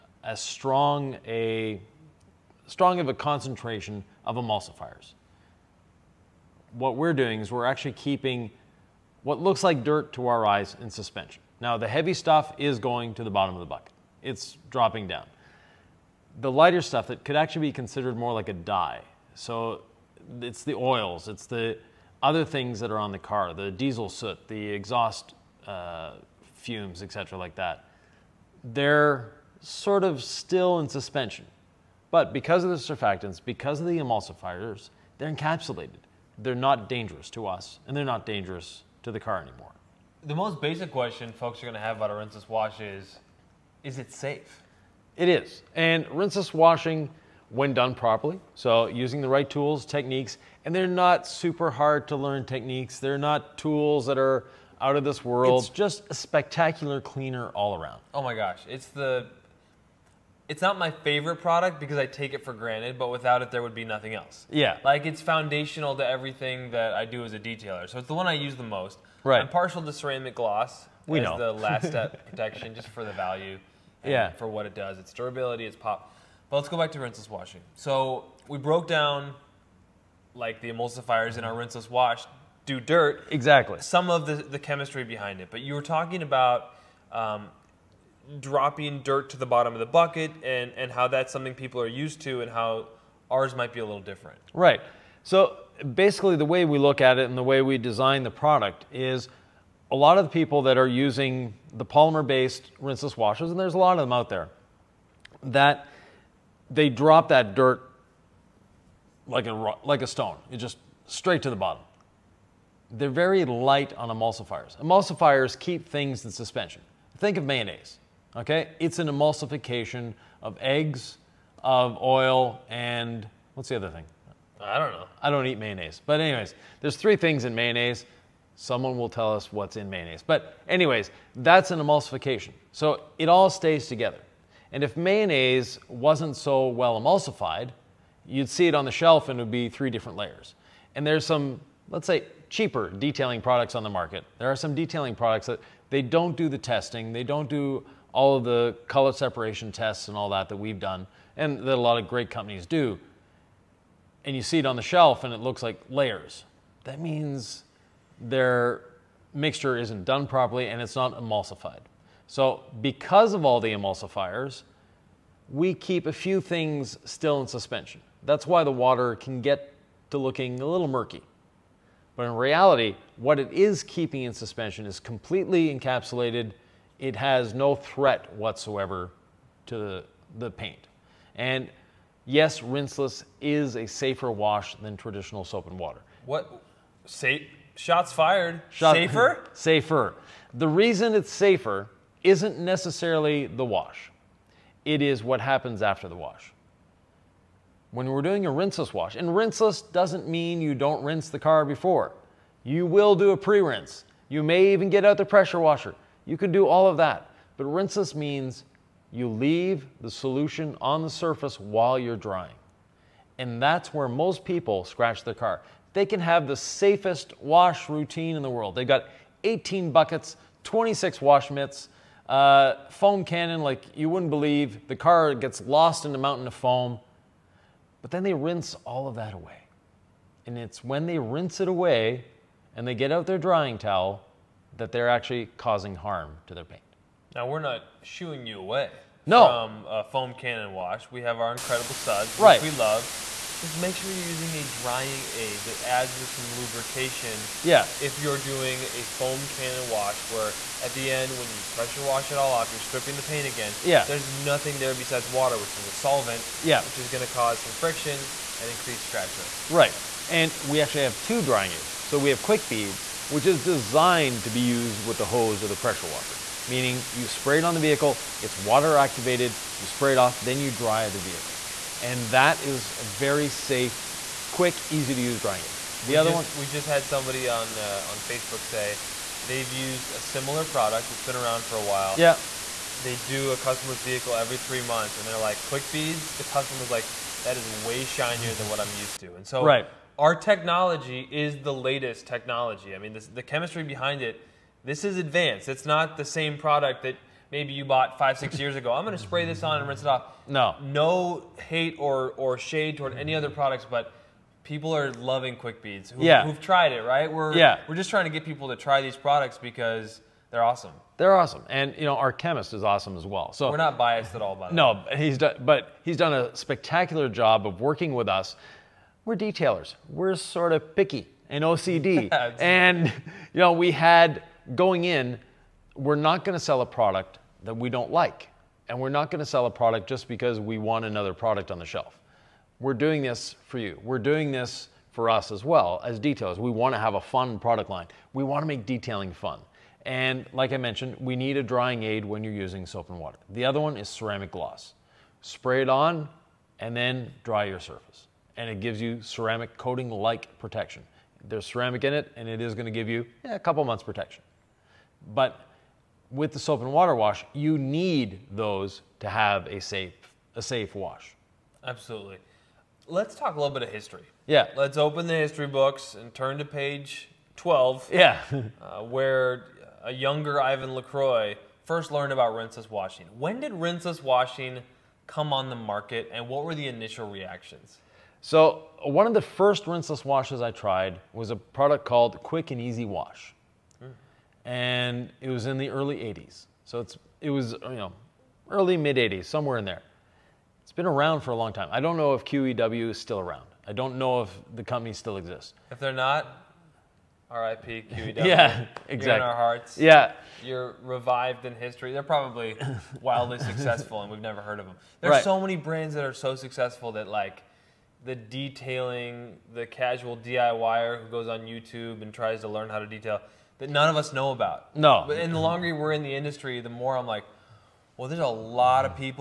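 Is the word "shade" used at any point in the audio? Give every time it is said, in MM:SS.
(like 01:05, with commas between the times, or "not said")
05:02.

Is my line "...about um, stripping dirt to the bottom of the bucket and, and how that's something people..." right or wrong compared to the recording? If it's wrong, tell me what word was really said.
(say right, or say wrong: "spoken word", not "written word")
wrong: "dropping", not "stripping".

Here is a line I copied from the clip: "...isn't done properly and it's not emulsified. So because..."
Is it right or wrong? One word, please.
right.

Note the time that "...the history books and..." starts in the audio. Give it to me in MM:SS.
06:05.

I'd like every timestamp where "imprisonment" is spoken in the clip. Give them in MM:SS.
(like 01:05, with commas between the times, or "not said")
not said.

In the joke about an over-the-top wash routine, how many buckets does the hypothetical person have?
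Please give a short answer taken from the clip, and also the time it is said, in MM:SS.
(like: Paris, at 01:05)
18, at 03:39.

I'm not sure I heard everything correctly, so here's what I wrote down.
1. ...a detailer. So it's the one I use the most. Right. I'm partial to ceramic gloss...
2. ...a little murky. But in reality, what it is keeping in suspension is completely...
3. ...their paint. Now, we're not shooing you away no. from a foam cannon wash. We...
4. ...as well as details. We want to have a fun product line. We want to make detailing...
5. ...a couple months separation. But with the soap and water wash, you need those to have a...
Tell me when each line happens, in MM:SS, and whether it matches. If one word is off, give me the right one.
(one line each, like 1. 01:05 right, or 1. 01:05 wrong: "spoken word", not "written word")
1. 01:07 right
2. 02:50 right
3. 03:56 right
4. 05:35 right
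5. 05:53 wrong: "protection", not "separation".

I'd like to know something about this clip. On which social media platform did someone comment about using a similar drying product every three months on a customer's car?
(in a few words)
Facebook.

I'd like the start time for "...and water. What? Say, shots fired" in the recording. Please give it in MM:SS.
03:05.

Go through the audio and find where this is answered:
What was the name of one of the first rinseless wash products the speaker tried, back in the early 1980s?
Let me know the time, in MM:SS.
06:22.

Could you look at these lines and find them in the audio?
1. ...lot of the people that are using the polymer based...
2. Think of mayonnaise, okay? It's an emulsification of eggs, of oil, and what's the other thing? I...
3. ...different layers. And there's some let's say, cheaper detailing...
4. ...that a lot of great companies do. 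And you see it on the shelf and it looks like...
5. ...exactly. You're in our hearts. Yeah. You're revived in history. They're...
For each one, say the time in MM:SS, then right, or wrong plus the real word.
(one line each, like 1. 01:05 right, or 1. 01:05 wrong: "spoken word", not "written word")
1. 01:39 right
2. 01:57 right
3. 02:19 right
4. 02:31 right
5. 06:39 right.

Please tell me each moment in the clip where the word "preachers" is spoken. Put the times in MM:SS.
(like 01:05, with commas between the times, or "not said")
not said.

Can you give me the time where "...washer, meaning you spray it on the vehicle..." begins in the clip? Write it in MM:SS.
04:26.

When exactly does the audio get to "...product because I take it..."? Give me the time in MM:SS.
01:01.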